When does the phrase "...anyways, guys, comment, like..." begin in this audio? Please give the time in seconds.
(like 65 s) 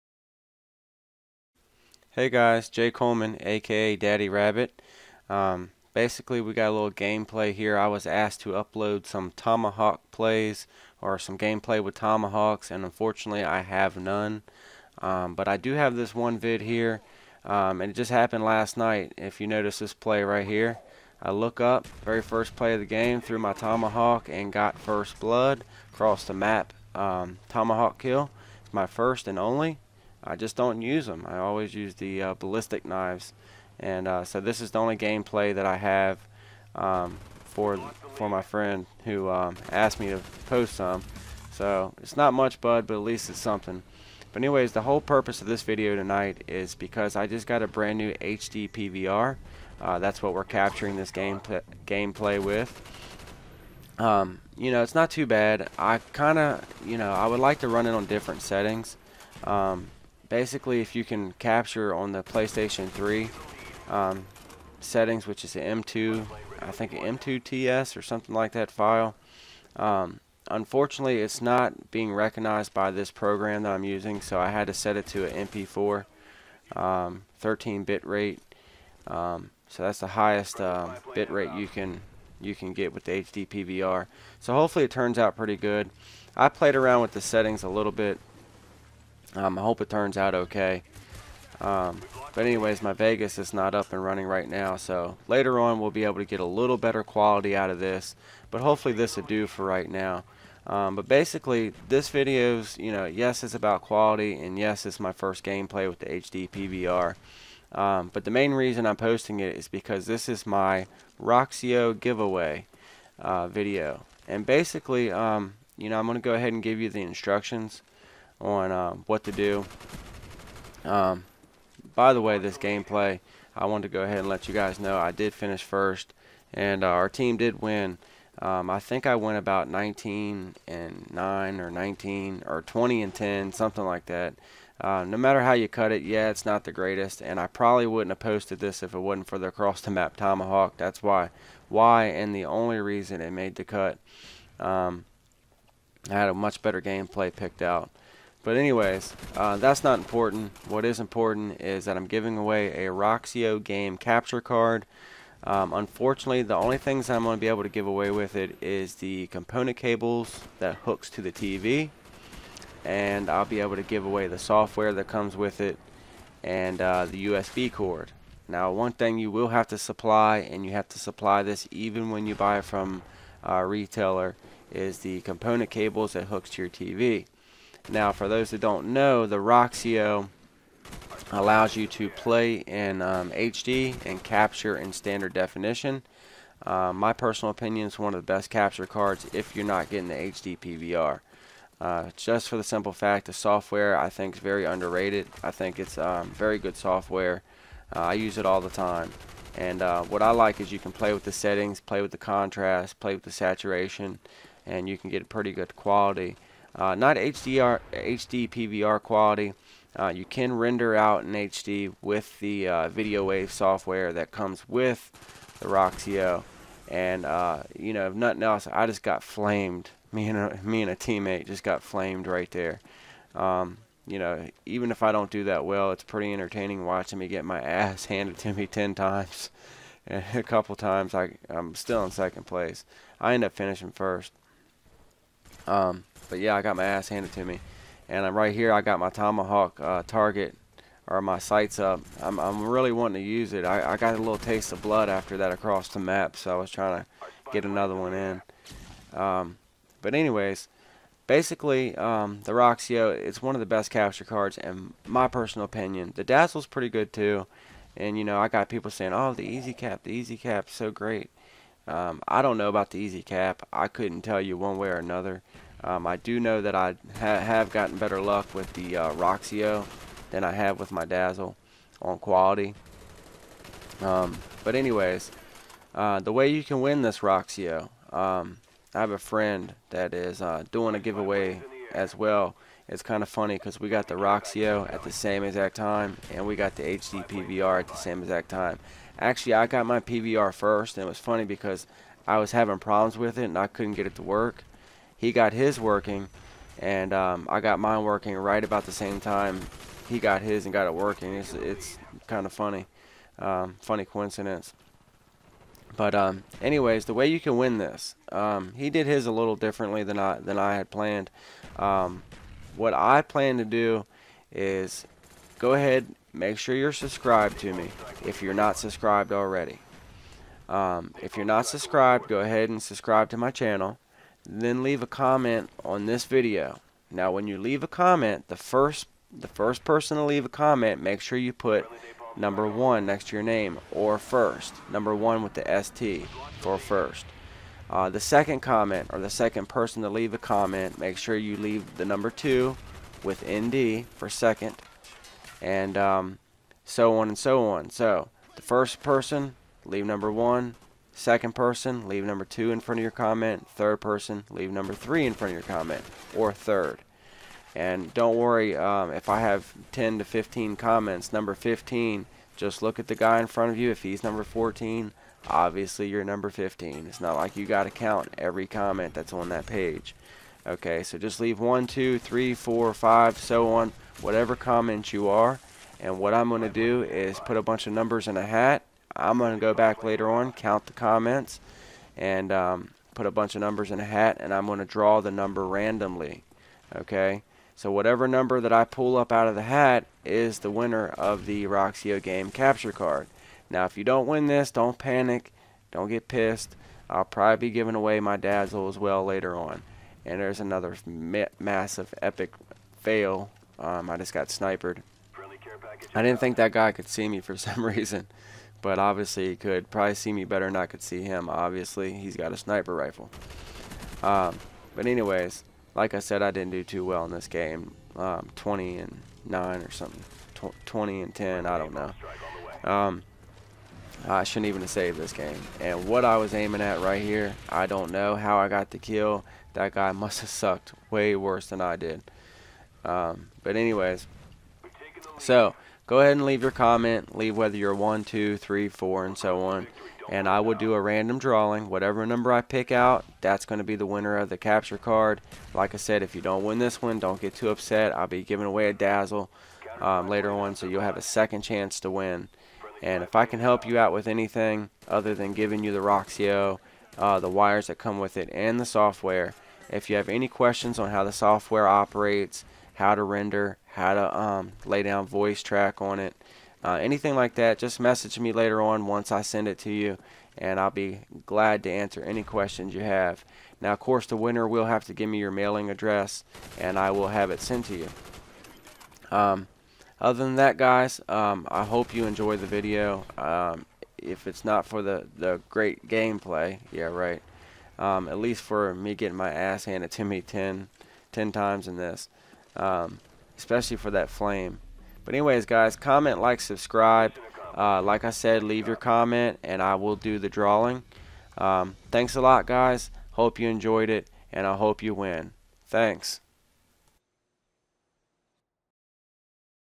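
495 s.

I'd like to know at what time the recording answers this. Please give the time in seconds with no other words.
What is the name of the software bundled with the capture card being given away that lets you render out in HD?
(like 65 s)
212 s.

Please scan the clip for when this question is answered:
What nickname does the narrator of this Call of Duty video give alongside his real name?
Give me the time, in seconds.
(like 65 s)
3 s.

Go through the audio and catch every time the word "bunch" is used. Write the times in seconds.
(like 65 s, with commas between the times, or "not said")
377 s, 383 s.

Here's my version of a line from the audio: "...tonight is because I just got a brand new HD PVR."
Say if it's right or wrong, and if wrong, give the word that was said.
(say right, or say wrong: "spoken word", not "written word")
right.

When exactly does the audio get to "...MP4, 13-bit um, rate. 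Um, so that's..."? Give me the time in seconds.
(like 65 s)
75 s.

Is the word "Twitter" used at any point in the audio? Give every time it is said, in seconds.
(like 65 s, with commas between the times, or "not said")
not said.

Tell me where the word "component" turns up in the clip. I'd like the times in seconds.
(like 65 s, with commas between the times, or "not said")
159 s, 175 s.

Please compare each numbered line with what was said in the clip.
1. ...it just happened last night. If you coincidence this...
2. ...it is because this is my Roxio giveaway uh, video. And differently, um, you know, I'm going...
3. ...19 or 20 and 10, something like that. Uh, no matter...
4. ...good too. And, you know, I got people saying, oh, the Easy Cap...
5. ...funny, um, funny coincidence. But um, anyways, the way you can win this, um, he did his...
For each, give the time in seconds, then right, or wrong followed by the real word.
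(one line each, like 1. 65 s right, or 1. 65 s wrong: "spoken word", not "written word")
1. 17 s wrong: "notice", not "coincidence"
2. 109 s wrong: "basically", not "differently"
3. 131 s right
4. 256 s right
5. 302 s right.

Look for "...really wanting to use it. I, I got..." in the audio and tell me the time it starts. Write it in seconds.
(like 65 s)
242 s.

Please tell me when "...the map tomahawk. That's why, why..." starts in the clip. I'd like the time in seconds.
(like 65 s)
139 s.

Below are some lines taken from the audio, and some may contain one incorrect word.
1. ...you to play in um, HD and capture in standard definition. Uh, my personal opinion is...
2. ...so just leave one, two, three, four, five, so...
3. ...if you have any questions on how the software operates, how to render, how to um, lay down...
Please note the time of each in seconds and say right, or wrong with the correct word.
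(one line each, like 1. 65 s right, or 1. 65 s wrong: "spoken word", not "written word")
1. 181 s right
2. 371 s right
3. 459 s right.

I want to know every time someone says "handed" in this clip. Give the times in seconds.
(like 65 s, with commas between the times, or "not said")
228 s, 237 s, 489 s.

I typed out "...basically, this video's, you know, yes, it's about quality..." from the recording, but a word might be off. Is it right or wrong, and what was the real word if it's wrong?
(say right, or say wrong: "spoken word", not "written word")
right.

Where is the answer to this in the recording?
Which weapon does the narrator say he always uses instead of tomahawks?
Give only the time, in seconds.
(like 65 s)
32 s.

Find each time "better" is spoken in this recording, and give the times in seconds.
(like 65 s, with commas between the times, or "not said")
96 s, 146 s, 267 s, 410 s.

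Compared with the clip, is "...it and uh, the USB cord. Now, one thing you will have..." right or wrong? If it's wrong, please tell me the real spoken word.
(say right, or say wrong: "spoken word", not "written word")
right.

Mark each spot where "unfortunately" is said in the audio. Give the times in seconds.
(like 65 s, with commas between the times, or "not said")
12 s, 70 s, 155 s.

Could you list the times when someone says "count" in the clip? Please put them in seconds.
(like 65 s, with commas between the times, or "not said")
367 s, 380 s.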